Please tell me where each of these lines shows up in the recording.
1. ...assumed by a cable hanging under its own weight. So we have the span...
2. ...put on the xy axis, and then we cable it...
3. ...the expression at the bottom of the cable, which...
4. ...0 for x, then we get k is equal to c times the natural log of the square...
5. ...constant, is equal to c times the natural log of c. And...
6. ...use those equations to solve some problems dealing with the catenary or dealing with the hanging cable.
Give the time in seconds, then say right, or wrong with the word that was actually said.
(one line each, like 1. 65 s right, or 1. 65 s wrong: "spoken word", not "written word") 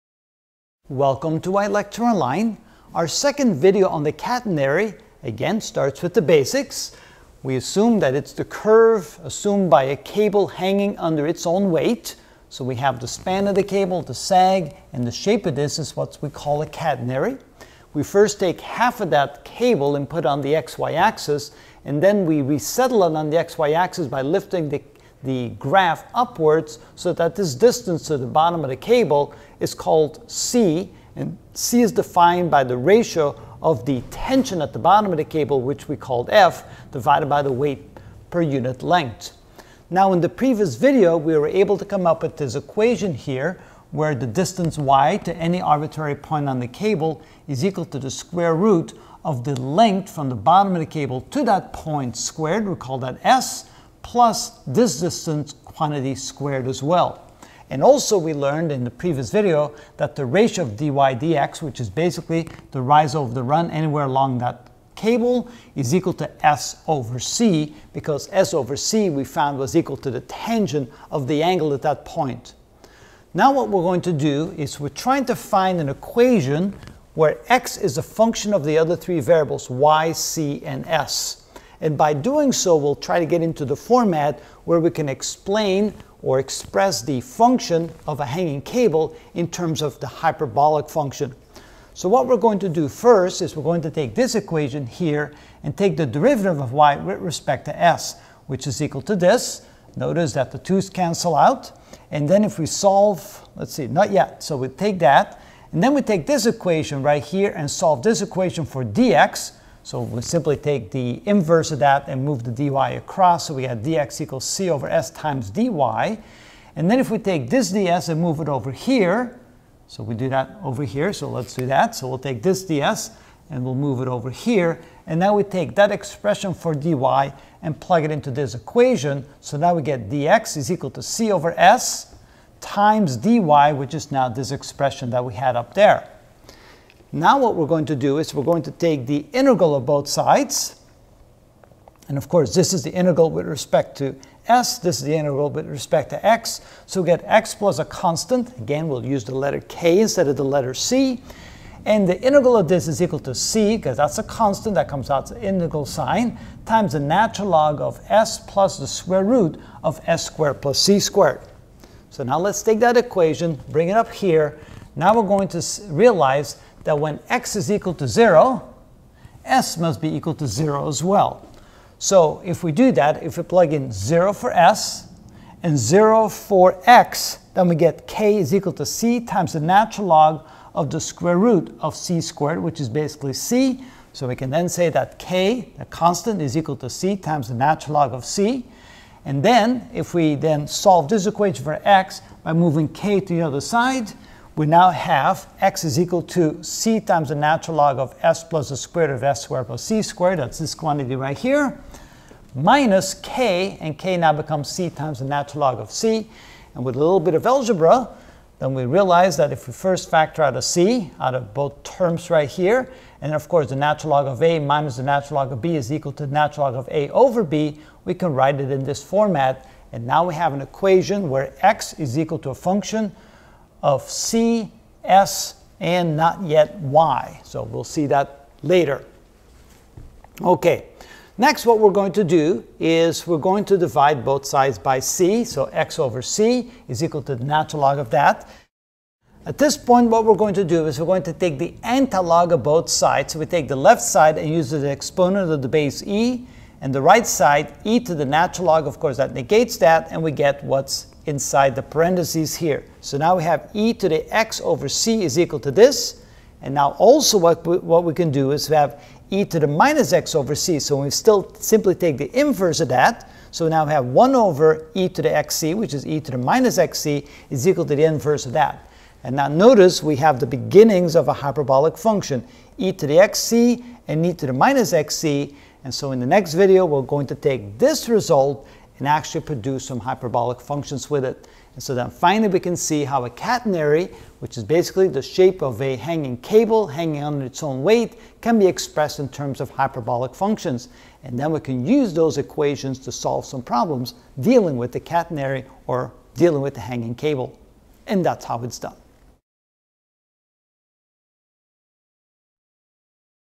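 1. 9 s right
2. 20 s wrong: "resettle", not "cable"
3. 33 s wrong: "tension", not "expression"
4. 175 s right
5. 185 s right
6. 291 s right.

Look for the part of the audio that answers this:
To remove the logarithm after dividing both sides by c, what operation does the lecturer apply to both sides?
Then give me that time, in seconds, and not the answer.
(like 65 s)
241 s.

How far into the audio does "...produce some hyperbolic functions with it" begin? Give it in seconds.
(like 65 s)
279 s.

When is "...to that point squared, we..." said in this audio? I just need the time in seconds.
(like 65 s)
51 s.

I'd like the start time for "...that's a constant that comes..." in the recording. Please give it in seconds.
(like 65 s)
153 s.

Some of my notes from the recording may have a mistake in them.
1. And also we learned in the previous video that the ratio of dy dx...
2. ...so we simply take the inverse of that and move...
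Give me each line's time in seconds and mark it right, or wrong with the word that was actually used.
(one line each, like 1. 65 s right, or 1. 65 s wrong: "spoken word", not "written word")
1. 57 s right
2. 109 s right.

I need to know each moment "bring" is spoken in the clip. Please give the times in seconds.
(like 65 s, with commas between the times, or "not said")
163 s.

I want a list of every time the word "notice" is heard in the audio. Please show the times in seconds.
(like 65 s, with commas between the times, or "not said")
99 s, 269 s.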